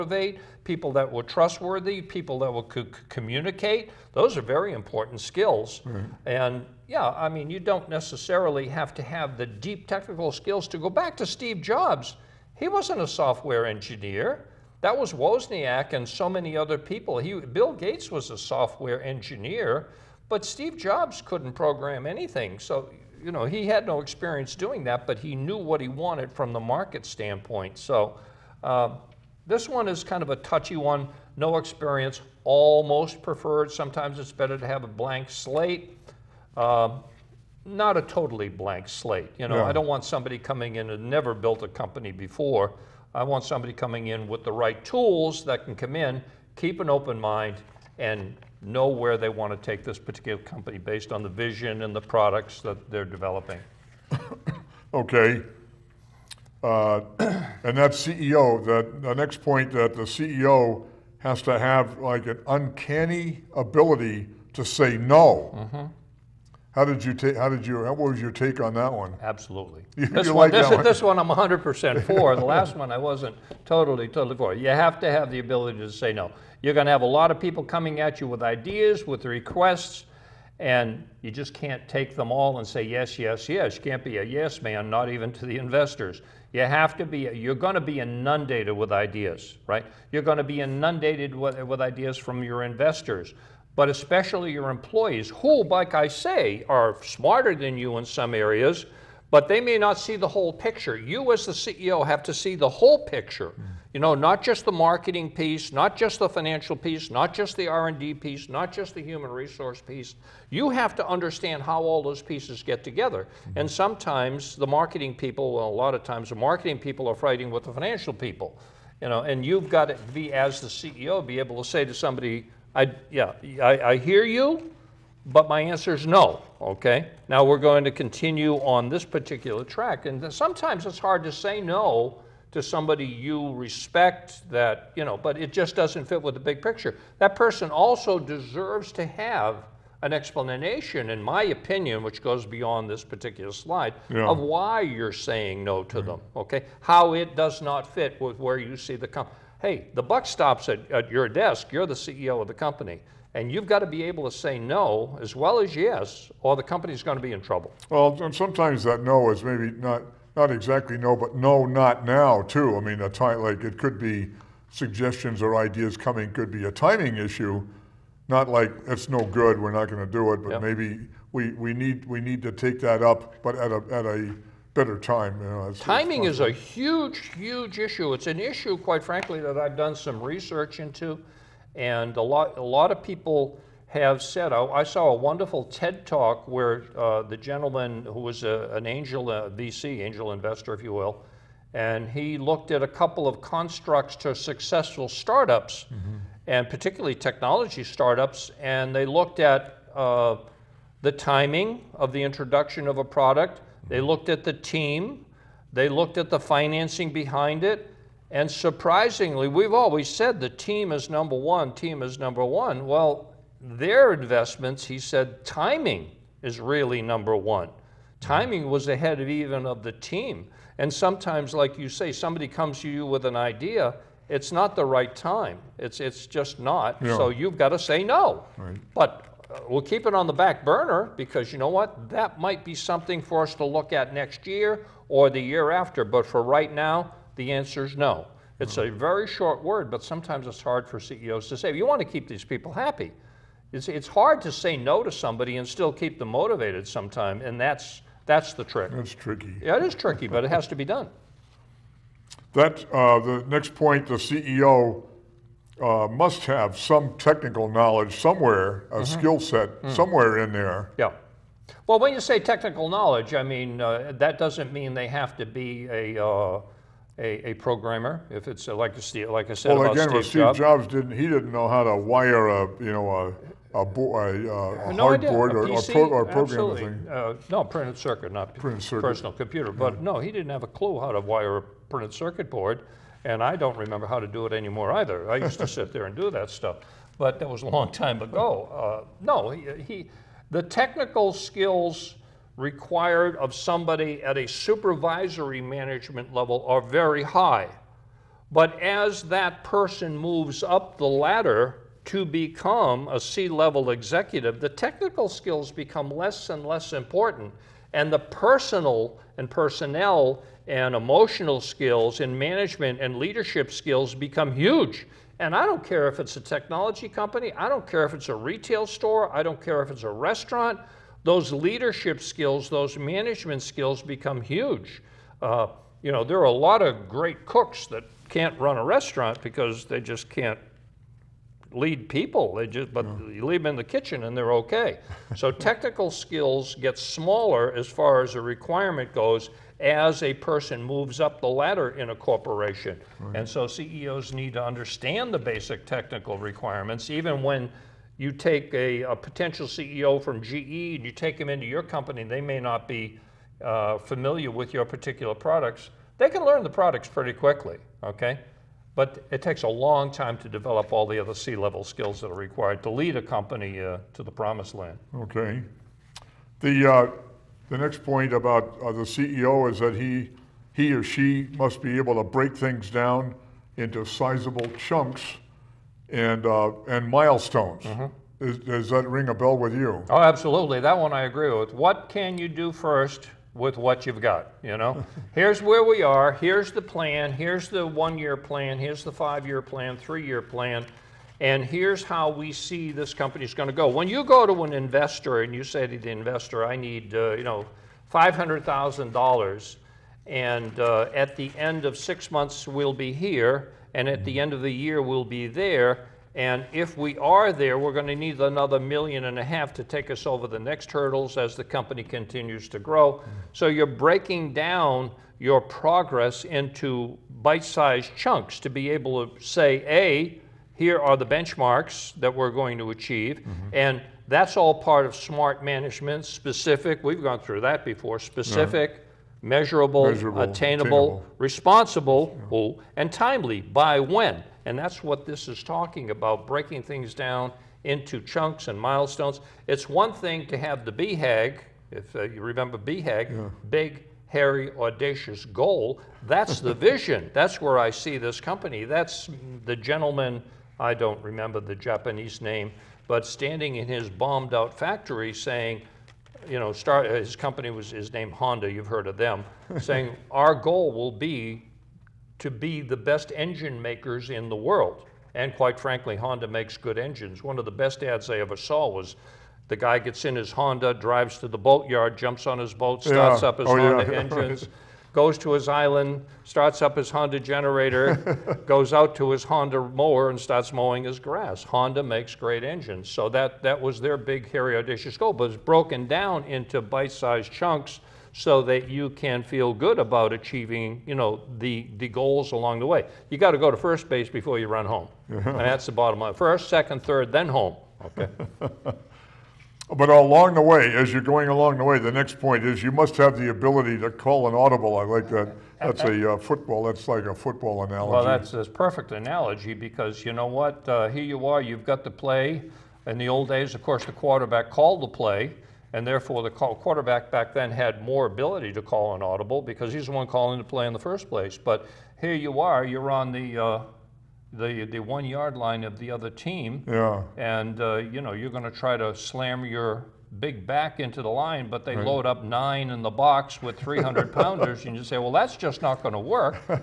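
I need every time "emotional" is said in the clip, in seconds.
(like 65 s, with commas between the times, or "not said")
310 s.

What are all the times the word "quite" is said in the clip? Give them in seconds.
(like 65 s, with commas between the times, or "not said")
178 s, 465 s.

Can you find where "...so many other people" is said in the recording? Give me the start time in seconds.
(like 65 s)
16 s.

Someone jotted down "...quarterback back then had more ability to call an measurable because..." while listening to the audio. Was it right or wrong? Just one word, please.
wrong.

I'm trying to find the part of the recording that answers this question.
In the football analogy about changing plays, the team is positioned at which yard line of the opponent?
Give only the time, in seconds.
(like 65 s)
524 s.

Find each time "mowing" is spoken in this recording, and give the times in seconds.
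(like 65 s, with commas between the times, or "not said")
480 s.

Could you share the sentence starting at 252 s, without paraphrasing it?
That, uh, the next point, the CEO uh, must have some technical knowledge somewhere, a mm -hmm.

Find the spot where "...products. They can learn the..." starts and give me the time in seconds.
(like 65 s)
355 s.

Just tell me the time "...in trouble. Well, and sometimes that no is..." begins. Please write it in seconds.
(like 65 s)
157 s.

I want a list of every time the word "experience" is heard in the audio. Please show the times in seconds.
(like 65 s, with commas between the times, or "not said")
24 s, 31 s.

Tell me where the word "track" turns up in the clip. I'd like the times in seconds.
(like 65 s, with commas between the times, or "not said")
129 s.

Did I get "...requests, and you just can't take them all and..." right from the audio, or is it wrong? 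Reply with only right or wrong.
right.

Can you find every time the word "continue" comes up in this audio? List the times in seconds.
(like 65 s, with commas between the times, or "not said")
127 s, 412 s.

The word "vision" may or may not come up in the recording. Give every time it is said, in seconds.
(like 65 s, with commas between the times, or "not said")
51 s, 446 s.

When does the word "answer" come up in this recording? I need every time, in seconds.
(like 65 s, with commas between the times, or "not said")
125 s, 237 s.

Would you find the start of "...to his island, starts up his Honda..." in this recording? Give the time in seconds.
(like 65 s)
475 s.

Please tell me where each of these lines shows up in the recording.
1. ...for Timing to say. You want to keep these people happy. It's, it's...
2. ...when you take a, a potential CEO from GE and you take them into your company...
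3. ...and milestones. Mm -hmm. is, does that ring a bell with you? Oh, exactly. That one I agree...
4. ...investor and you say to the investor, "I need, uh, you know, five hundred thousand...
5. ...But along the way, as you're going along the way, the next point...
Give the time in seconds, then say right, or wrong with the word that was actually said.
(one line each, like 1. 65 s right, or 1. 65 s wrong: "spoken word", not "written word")
1. 240 s wrong: "CEOs", not "Timing"
2. 347 s right
3. 376 s wrong: "absolutely", not "exactly"
4. 394 s right
5. 499 s right.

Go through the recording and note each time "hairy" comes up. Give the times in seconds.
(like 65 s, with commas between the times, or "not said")
444 s, 484 s.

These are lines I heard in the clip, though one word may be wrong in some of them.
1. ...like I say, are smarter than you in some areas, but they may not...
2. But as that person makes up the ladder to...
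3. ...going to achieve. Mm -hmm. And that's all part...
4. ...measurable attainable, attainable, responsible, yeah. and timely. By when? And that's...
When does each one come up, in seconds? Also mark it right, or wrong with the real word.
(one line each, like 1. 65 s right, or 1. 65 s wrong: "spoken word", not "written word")
1. 95 s right
2. 298 s wrong: "moves", not "makes"
3. 422 s right
4. 430 s right.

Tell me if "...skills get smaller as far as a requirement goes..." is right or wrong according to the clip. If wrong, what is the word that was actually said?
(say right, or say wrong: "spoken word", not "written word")
right.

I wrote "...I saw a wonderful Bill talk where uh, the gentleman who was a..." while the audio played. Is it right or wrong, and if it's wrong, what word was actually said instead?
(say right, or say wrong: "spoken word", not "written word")
wrong: "TED", not "Bill".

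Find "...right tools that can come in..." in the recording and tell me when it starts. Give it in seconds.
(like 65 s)
44 s.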